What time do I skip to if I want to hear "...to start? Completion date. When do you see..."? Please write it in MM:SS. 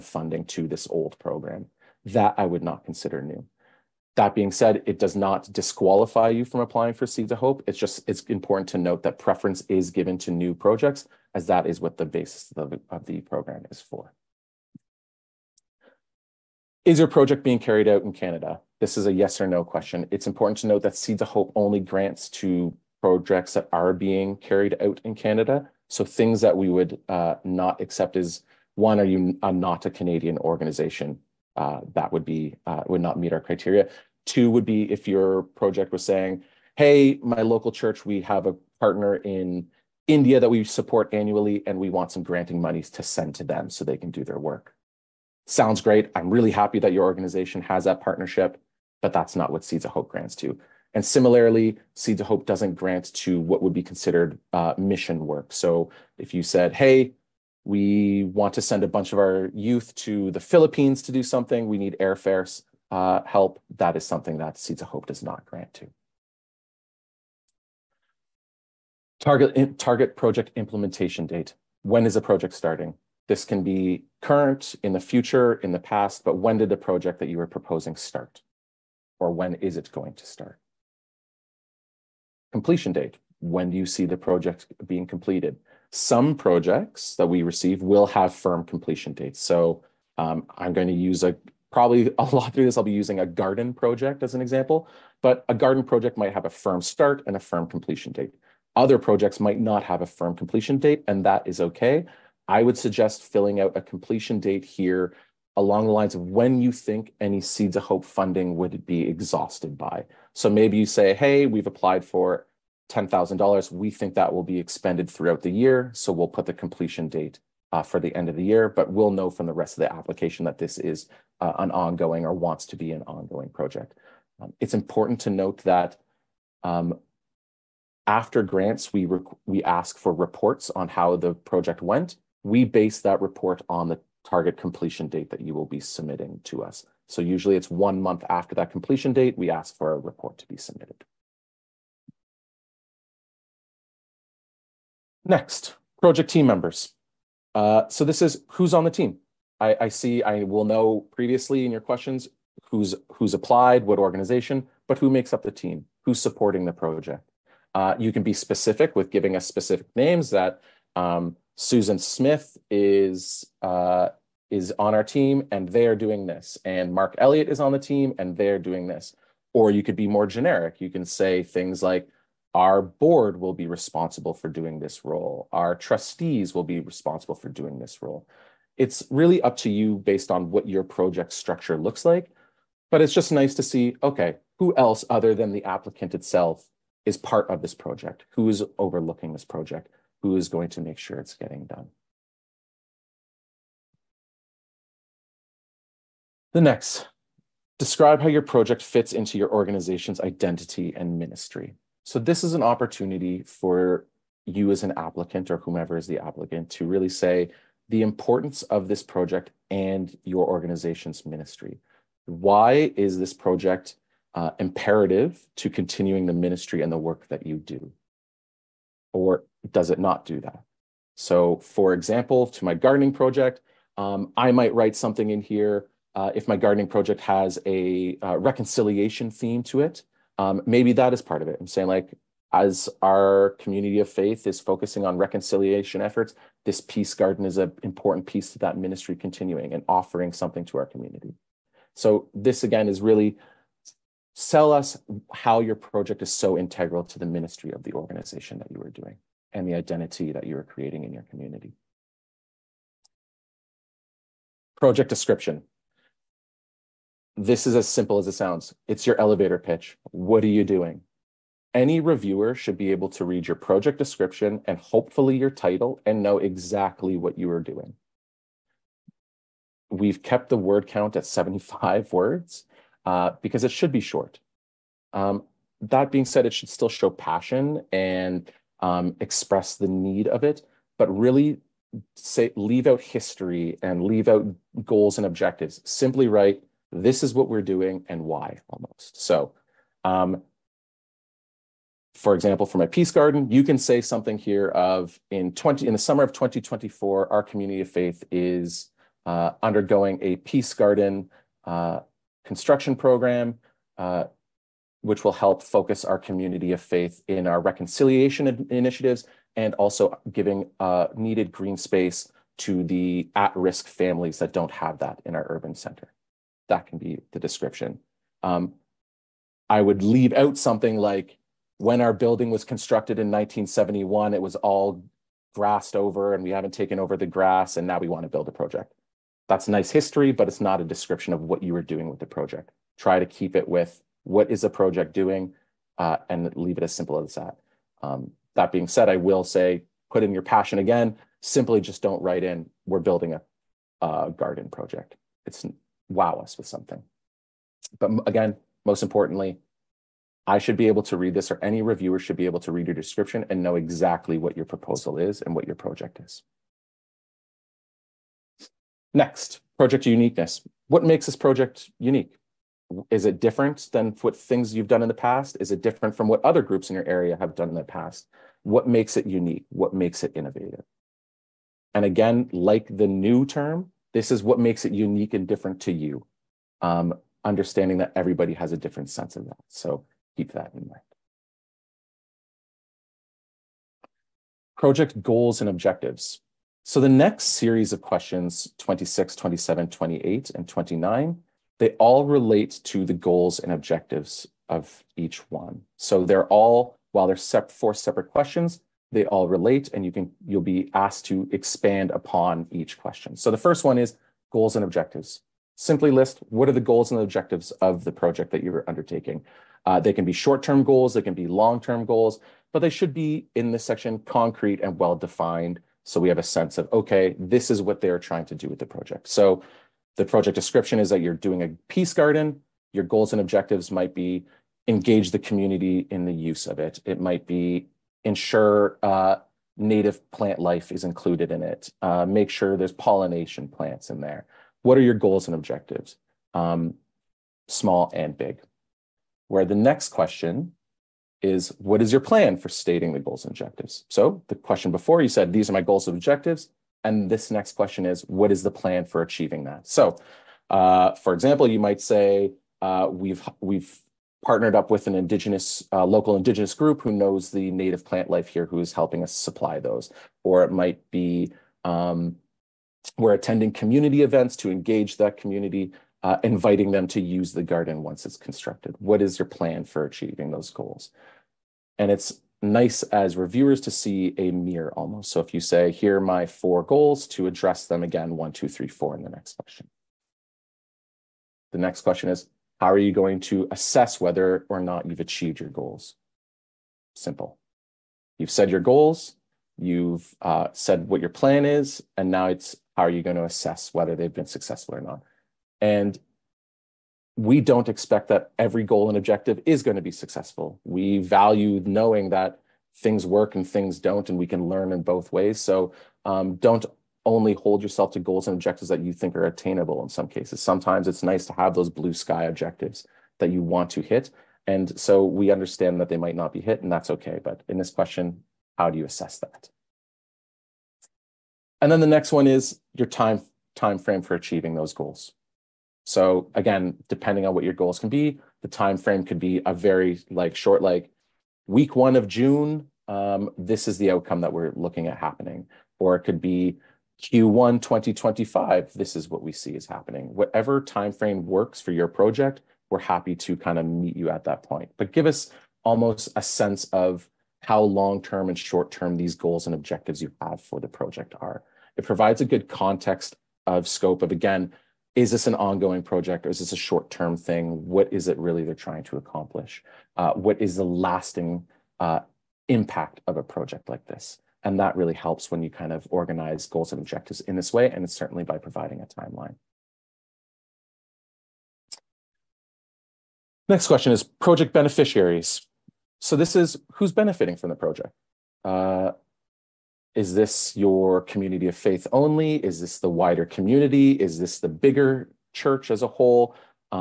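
01:20.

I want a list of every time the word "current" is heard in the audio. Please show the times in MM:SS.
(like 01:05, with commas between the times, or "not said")
01:14.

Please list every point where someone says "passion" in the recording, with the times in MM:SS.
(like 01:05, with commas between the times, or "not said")
04:37, 05:40.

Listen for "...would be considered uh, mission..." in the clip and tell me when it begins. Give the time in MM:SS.
00:53.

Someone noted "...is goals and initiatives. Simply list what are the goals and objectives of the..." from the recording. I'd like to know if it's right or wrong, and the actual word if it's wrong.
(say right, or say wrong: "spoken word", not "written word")
wrong: "objectives", not "initiatives".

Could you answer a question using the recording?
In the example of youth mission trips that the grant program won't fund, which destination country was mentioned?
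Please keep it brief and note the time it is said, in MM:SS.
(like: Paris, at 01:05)
Philippines, at 01:00.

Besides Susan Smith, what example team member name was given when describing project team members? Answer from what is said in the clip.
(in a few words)
Mark Elliott.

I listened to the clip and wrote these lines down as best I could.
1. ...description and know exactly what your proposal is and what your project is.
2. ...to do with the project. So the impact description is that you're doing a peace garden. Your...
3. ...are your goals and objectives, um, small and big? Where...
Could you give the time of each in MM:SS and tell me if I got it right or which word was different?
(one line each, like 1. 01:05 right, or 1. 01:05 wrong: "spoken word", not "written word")
1. 05:52 right
2. 06:58 wrong: "project", not "impact"
3. 07:14 right.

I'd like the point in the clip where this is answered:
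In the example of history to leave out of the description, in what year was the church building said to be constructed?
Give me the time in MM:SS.
05:23.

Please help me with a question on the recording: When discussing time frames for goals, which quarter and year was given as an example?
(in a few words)
Q1 2025.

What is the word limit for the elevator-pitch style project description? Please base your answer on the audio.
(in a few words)
75 words.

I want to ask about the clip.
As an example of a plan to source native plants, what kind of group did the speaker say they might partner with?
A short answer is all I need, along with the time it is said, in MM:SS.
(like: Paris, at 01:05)
local indigenous group, at 07:36.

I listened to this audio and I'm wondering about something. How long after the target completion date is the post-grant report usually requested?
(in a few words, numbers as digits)
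1 month.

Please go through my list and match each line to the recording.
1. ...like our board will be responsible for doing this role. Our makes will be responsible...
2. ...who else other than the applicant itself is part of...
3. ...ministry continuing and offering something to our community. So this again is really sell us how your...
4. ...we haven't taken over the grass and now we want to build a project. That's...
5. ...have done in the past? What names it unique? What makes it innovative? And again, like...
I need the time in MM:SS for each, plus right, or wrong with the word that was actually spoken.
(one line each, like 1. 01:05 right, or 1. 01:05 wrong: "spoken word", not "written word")
1. 02:51 wrong: "trustees", not "makes"
2. 03:04 right
3. 03:58 right
4. 05:26 right
5. 06:07 wrong: "makes", not "names".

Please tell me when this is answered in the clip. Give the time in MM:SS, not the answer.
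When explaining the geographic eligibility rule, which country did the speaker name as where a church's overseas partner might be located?
00:40.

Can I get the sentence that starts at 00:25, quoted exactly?
So things that we would uh, not accept is one, are you uh, not a Canadian organization?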